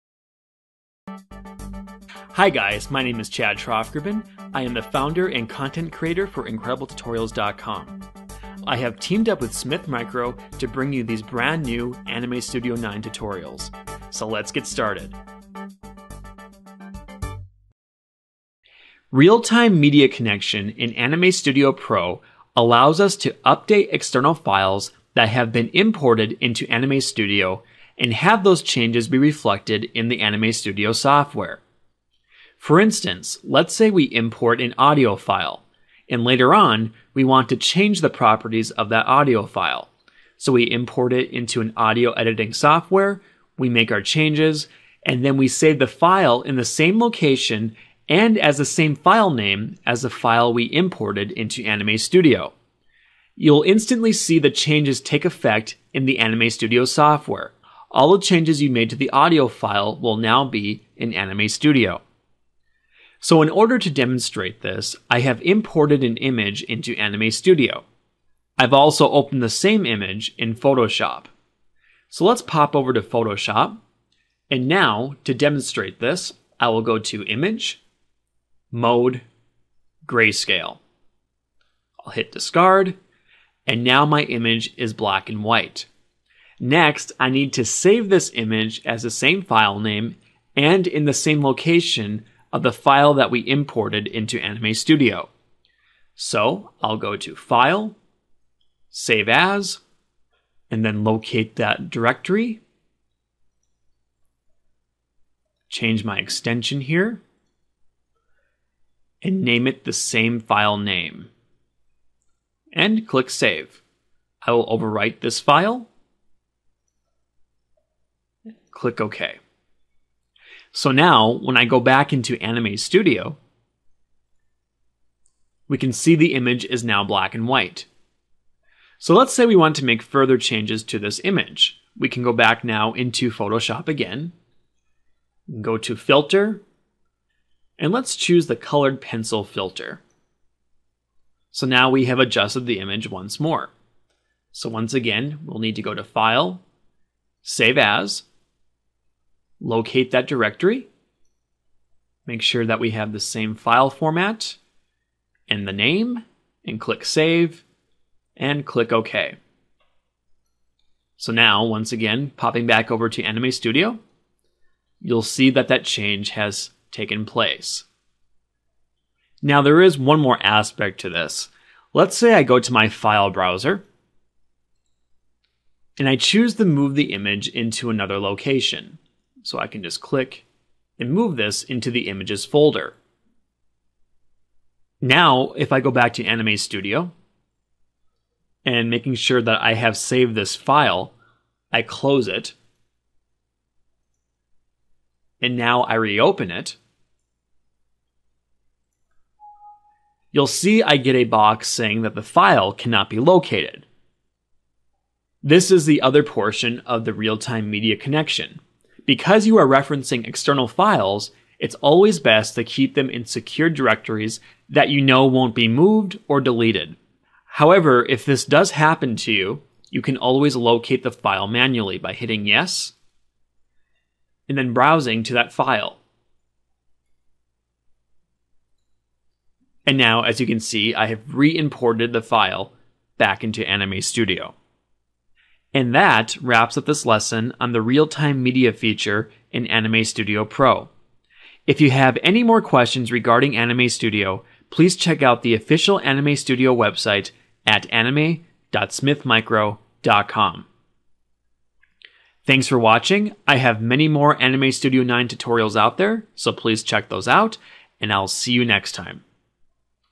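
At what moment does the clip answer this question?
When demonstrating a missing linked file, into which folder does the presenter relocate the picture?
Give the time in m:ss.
3:02.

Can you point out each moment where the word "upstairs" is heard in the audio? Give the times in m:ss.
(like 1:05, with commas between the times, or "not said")
not said.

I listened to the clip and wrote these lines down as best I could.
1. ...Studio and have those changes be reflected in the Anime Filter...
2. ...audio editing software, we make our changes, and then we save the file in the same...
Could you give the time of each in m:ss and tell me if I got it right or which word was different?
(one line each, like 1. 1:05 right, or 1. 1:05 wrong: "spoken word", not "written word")
1. 0:27 wrong: "Studio", not "Filter"
2. 0:41 right.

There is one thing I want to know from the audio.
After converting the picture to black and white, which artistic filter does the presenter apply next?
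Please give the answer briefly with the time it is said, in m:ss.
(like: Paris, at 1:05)
Colored Pencil, at 2:18.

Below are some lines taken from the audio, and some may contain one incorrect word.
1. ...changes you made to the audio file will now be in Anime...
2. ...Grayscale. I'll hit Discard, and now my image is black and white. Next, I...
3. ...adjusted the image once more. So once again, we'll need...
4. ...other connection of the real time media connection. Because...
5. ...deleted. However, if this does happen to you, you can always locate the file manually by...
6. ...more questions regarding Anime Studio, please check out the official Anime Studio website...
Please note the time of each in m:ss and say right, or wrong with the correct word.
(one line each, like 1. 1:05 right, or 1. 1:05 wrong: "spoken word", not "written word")
1. 0:58 right
2. 1:20 right
3. 2:22 right
4. 3:26 wrong: "portion", not "connection"
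5. 3:36 right
6. 4:02 right.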